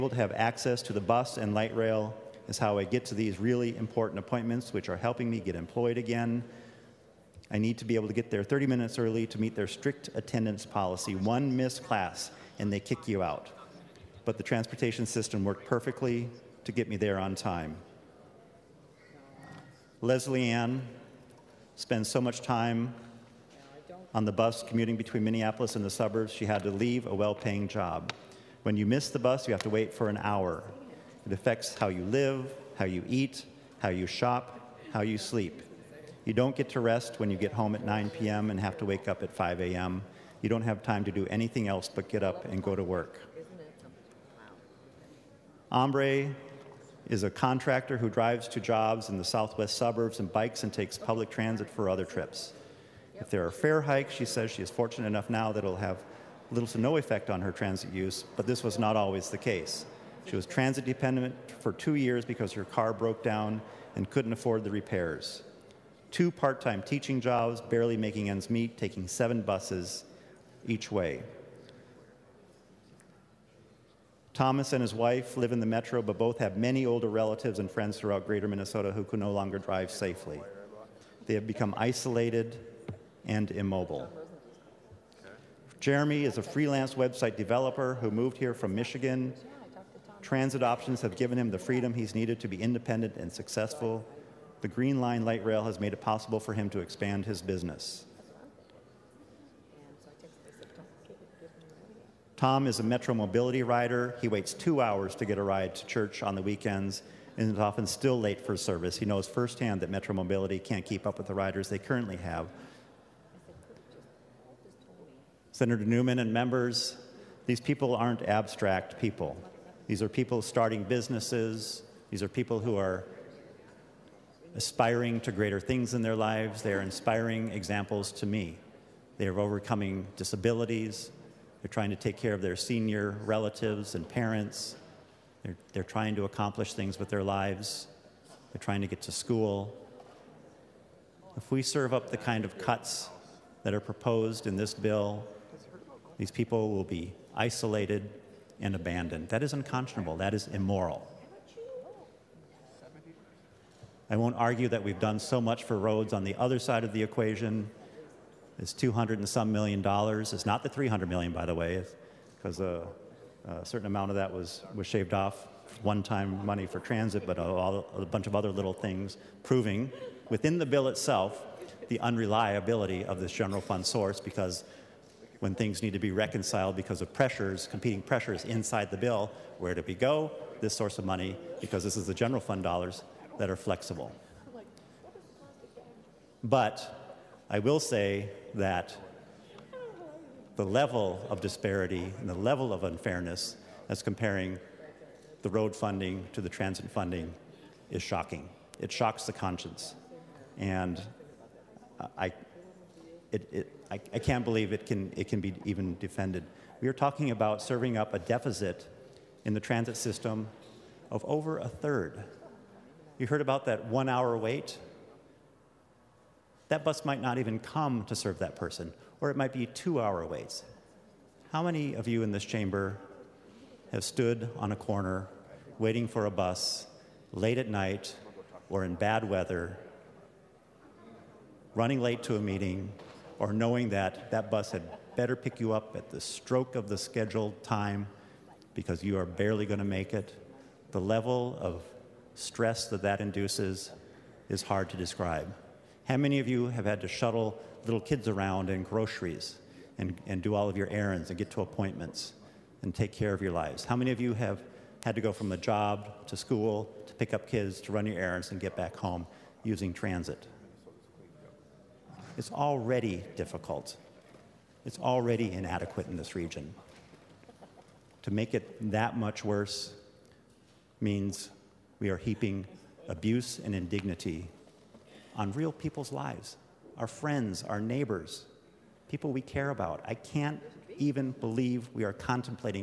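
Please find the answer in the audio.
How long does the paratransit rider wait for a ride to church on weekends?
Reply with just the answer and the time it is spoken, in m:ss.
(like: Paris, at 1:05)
2 hours, at 1:44.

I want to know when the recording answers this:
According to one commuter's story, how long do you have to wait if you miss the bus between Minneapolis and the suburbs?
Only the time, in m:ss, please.
0:30.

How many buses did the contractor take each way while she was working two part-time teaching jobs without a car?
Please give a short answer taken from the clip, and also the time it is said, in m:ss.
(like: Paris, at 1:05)
7, at 1:09.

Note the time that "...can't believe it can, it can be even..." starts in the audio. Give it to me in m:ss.
3:24.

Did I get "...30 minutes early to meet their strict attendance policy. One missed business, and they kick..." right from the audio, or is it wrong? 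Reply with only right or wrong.
wrong.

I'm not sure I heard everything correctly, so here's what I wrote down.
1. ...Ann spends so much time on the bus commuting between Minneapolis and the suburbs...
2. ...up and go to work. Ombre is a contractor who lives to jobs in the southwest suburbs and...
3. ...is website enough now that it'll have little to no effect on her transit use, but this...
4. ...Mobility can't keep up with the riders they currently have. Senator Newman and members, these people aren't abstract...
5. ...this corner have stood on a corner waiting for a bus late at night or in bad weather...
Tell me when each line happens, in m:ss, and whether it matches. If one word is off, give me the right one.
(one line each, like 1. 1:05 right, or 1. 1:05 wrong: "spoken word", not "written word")
1. 0:20 right
2. 0:42 wrong: "drives", not "lives"
3. 0:54 wrong: "fortunate", not "website"
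4. 1:50 right
5. 3:42 wrong: "chamber", not "corner".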